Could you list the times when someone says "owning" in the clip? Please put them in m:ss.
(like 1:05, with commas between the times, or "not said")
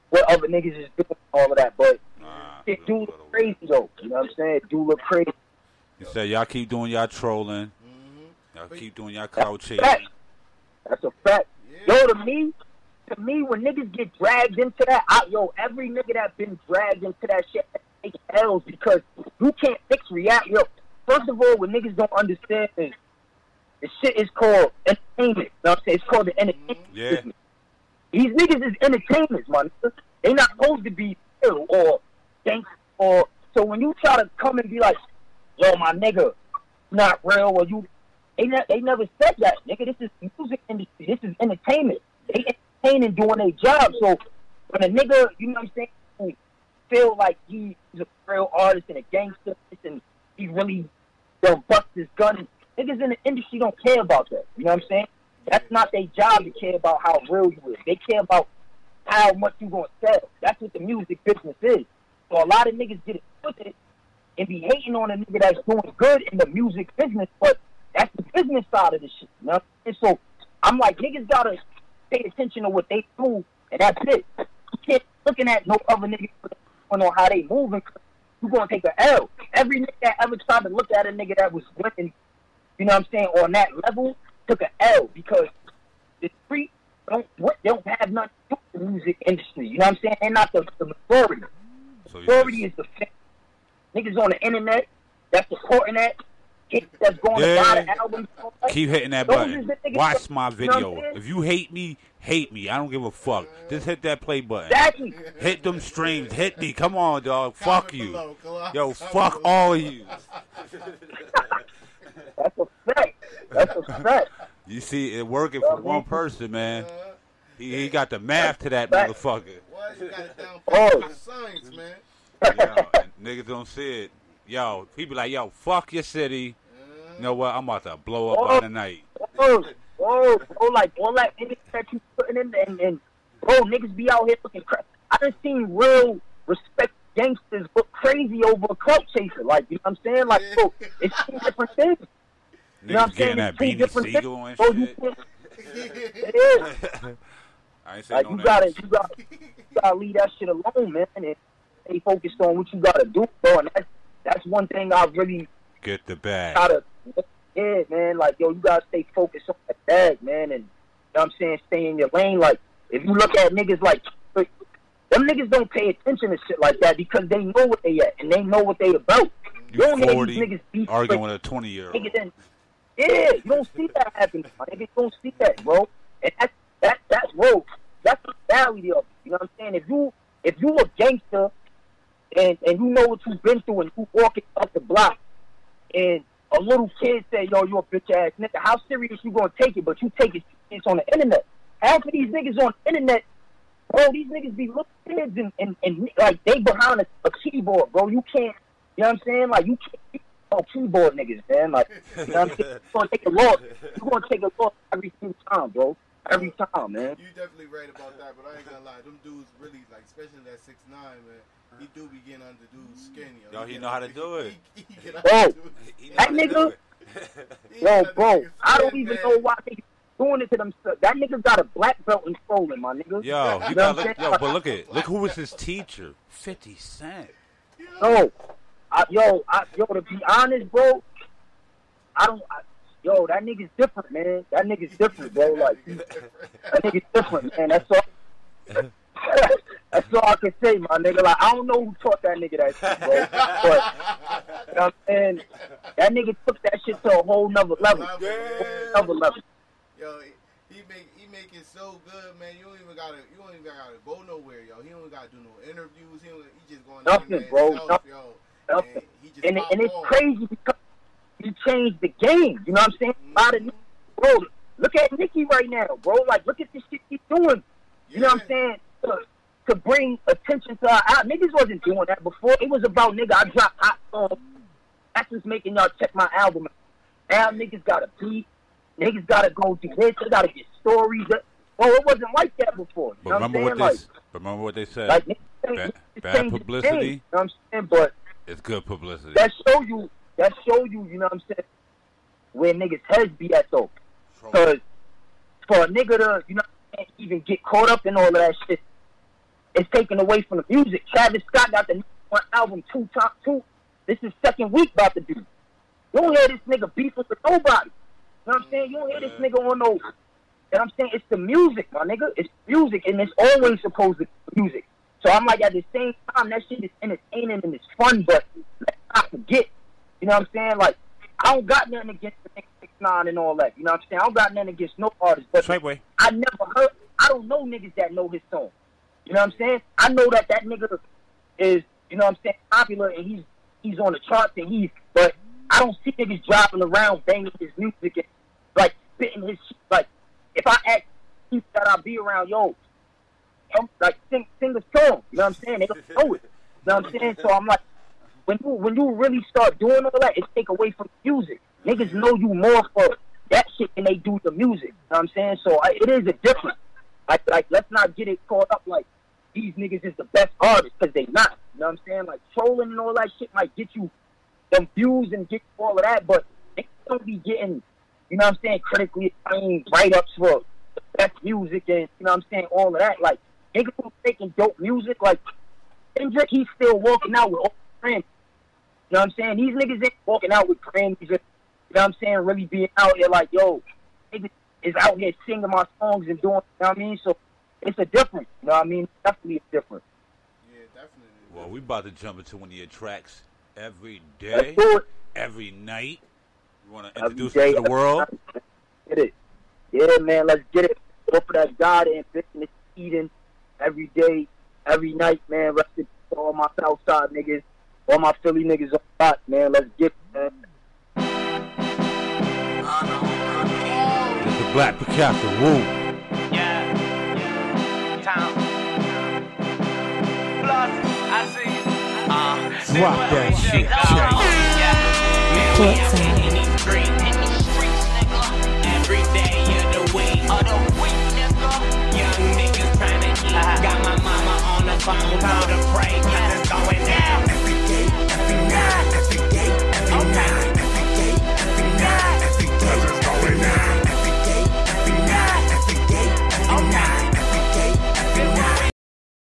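not said.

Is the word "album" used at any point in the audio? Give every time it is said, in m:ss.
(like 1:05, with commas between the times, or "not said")
4:36, 5:02.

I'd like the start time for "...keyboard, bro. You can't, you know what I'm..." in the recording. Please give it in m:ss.
3:17.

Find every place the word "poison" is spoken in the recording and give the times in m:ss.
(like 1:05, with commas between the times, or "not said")
not said.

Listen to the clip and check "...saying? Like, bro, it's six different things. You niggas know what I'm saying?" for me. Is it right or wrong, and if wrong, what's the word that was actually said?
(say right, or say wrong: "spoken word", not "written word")
wrong: "two", not "six".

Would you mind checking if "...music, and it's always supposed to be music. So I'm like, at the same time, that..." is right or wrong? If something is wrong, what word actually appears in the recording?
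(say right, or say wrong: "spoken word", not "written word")
right.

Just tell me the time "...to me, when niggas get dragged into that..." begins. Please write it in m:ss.
0:13.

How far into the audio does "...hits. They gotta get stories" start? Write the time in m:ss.
4:39.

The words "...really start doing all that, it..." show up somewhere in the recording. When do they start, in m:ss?
5:49.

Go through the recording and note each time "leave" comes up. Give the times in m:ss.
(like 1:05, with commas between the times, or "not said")
2:29.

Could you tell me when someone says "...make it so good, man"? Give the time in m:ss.
4:11.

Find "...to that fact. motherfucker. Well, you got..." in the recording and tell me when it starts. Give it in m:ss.
1:58.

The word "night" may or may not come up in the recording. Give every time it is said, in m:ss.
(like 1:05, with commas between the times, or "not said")
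2:08, 6:35, 6:45.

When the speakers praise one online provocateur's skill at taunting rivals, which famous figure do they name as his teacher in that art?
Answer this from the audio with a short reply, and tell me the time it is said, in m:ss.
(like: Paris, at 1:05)
50 Cent, at 3:46.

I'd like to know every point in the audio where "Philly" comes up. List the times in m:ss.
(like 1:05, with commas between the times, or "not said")
6:48.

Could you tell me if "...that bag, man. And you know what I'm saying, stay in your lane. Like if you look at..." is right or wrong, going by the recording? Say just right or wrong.
right.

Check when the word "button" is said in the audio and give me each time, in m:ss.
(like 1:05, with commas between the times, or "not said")
1:39, 1:44.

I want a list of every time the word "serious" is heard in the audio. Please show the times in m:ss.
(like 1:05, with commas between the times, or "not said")
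3:08.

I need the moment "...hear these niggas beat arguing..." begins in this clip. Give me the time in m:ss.
2:50.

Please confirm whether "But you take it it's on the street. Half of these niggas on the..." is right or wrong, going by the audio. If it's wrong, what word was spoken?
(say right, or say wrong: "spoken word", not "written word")
wrong: "internet", not "street".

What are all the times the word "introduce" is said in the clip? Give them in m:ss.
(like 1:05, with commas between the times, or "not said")
6:37.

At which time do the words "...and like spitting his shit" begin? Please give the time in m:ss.
5:38.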